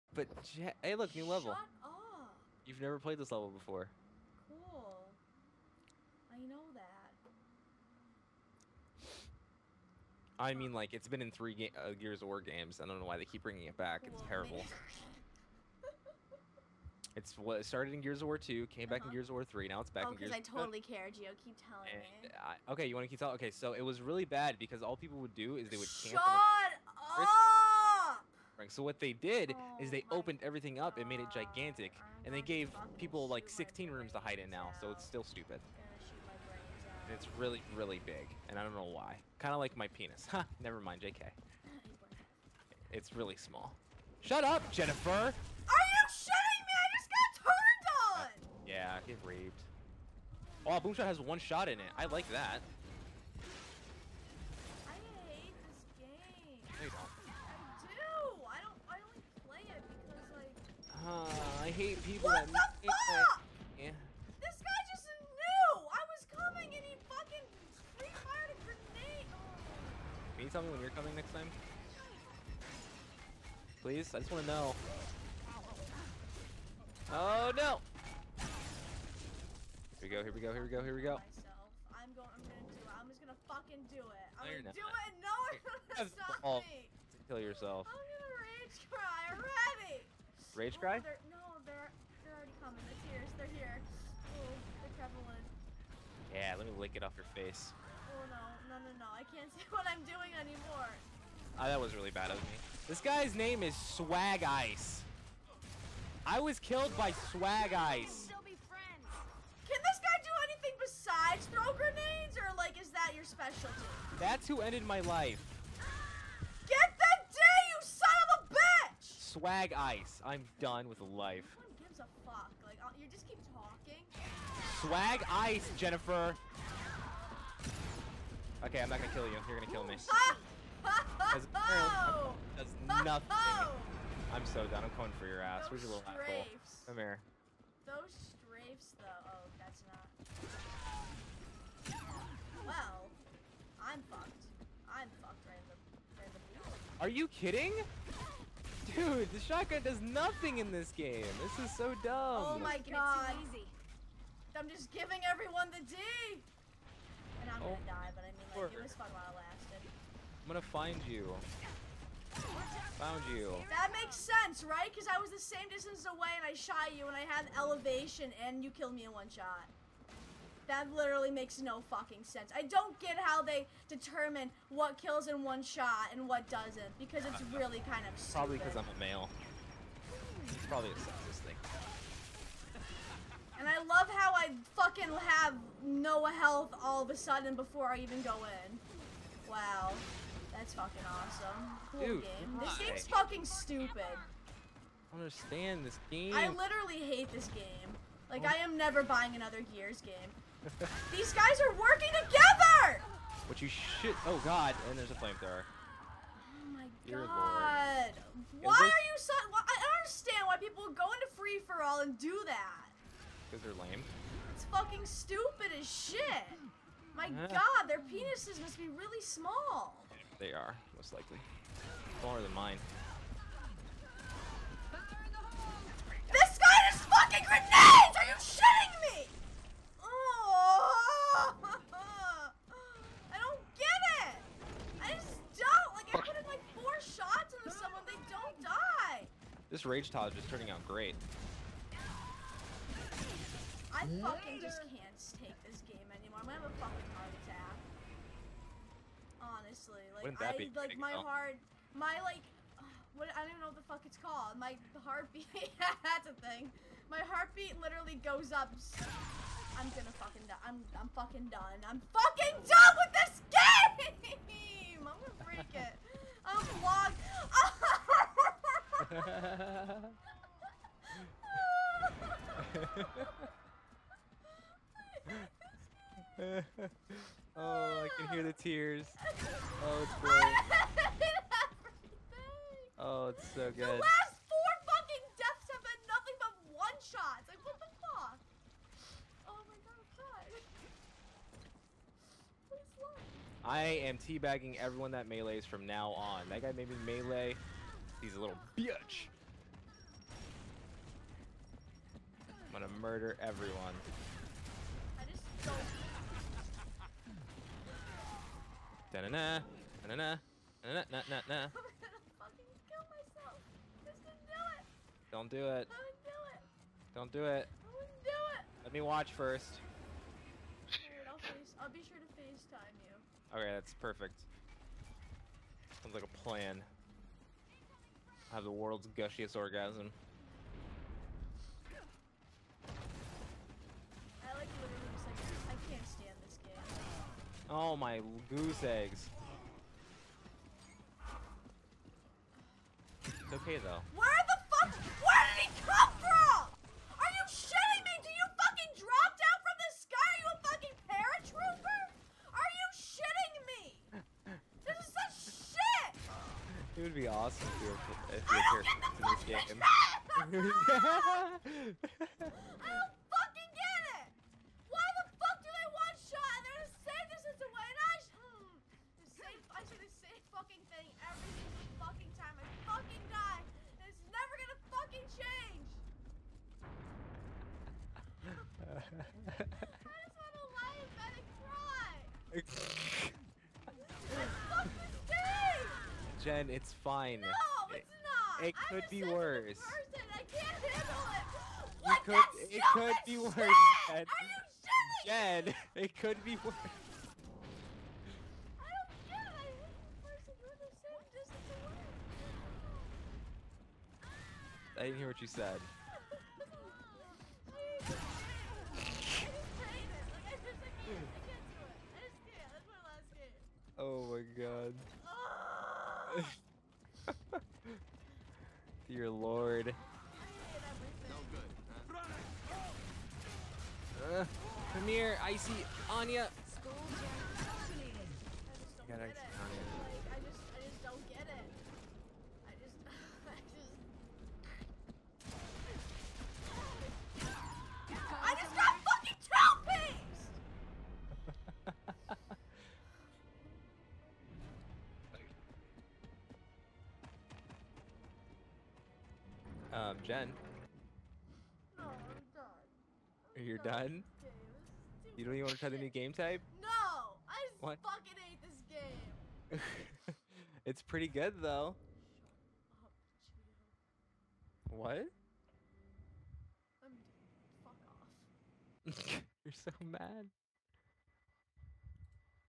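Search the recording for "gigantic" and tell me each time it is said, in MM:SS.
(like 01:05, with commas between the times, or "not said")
00:31.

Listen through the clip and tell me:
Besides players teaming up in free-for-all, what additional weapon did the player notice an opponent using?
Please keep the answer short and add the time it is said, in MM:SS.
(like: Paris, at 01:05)
flamethrower, at 03:25.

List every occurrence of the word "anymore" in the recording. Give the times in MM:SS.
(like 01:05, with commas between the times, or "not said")
01:40, 04:06.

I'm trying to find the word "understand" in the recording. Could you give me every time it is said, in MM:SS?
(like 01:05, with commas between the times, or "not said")
03:15, 03:30.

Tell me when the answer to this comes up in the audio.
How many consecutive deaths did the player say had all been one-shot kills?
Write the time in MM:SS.
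04:44.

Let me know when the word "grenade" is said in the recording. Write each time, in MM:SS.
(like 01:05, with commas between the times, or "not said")
01:08, 01:51, 03:47.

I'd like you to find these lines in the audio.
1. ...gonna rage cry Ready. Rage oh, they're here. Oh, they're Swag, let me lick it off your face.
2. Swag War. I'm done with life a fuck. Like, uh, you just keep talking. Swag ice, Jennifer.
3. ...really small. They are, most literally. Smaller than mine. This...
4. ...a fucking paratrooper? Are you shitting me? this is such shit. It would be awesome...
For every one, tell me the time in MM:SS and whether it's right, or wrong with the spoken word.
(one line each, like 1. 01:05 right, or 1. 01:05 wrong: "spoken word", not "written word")
1. 01:27 wrong: "Yeah", not "Swag"
2. 01:59 wrong: "Ice", not "War"
3. 03:38 wrong: "likely", not "literally"
4. 05:50 right.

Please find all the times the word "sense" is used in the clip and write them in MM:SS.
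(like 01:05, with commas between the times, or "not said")
02:44, 02:52.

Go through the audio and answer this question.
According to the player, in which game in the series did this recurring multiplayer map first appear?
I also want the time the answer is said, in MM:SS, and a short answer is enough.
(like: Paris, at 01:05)
Gears of War 2, at 00:17.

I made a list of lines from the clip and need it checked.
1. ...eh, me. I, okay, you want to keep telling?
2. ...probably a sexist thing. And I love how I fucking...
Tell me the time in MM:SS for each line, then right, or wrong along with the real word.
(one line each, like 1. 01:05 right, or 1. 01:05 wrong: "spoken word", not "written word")
1. 00:21 right
2. 03:00 right.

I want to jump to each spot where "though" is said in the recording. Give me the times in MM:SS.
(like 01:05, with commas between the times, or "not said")
02:18, 05:43, 07:41.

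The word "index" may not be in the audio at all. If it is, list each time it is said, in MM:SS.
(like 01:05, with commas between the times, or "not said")
not said.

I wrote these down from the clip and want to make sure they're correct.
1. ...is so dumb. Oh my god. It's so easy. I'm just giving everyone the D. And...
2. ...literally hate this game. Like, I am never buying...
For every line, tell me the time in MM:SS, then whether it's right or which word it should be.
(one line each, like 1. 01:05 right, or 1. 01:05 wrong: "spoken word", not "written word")
1. 02:31 right
2. 03:16 right.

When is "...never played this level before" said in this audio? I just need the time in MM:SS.
00:02.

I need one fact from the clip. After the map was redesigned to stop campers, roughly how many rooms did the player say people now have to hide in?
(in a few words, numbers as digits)
16.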